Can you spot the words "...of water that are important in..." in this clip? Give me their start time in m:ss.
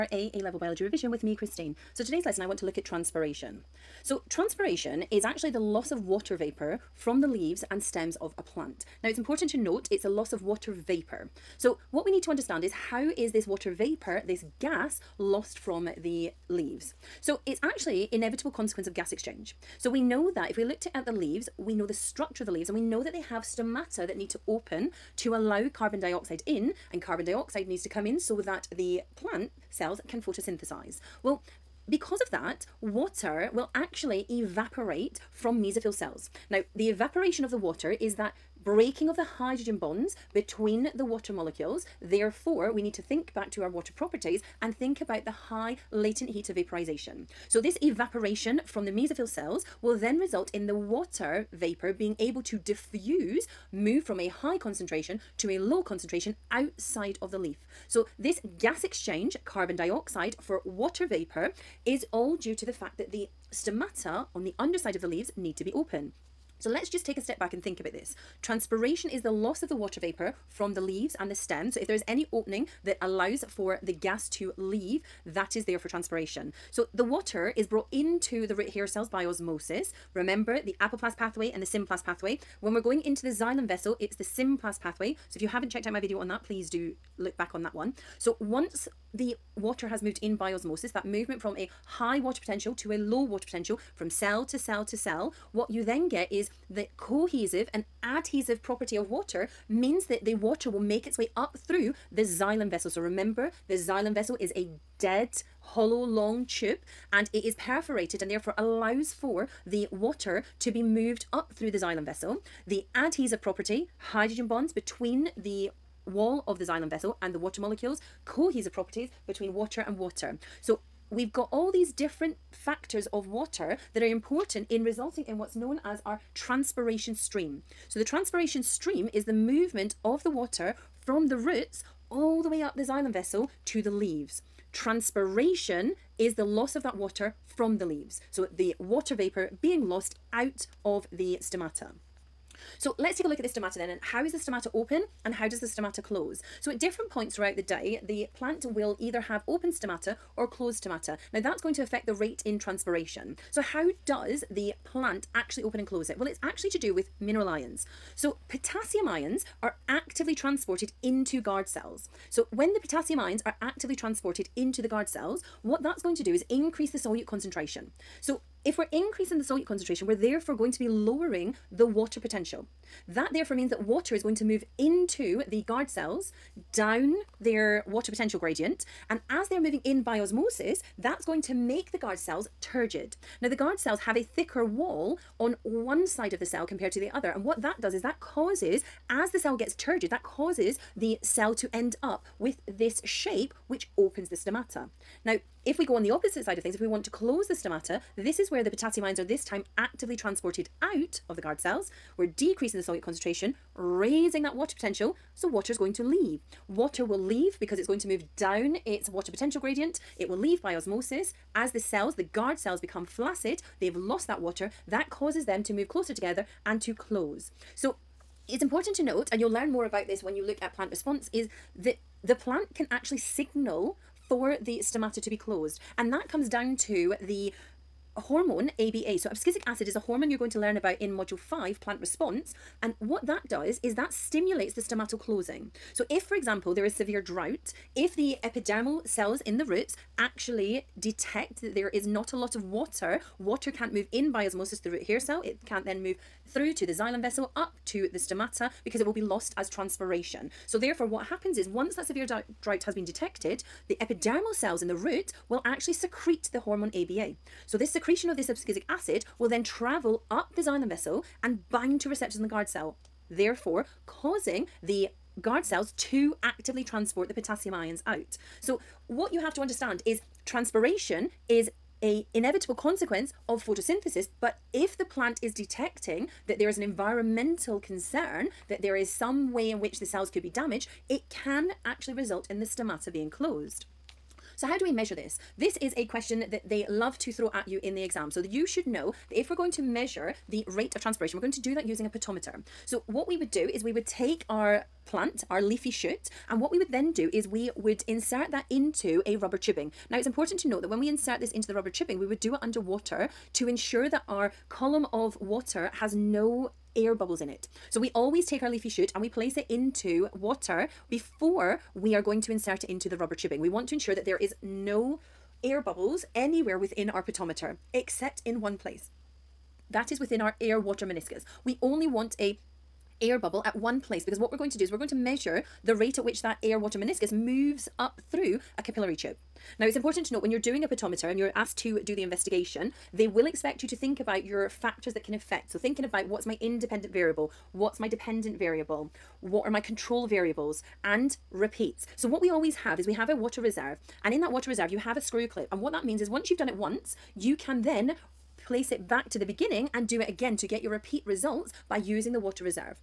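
2:03.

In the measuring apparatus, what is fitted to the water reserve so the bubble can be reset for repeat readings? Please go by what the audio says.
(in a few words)
a screw clip.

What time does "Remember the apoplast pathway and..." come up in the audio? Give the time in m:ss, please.
1:20.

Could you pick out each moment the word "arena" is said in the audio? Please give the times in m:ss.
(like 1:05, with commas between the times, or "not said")
not said.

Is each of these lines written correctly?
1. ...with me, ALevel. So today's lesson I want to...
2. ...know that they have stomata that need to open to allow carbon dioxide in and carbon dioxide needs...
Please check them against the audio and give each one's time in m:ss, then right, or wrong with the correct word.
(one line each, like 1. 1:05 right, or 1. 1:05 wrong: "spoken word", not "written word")
1. 0:01 wrong: "Christine", not "ALevel"
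2. 0:22 right.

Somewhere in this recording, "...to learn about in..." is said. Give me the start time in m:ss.
3:50.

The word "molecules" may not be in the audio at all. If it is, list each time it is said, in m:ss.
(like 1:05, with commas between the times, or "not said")
0:41, 1:57.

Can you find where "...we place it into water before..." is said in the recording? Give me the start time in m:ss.
5:09.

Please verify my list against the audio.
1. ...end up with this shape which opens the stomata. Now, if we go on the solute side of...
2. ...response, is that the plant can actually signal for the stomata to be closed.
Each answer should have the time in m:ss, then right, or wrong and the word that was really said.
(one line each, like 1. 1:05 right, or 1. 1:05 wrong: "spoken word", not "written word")
1. 3:11 wrong: "opposite", not "solute"
2. 3:40 right.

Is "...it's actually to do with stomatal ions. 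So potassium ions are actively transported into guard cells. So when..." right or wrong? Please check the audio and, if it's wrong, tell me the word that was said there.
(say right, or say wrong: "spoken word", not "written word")
wrong: "mineral", not "stomatal".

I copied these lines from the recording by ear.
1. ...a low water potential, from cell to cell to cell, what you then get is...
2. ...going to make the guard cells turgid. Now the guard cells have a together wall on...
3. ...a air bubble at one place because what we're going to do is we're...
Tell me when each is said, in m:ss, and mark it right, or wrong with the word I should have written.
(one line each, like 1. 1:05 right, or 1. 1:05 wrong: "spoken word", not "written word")
1. 1:32 right
2. 3:01 wrong: "thicker", not "together"
3. 5:22 right.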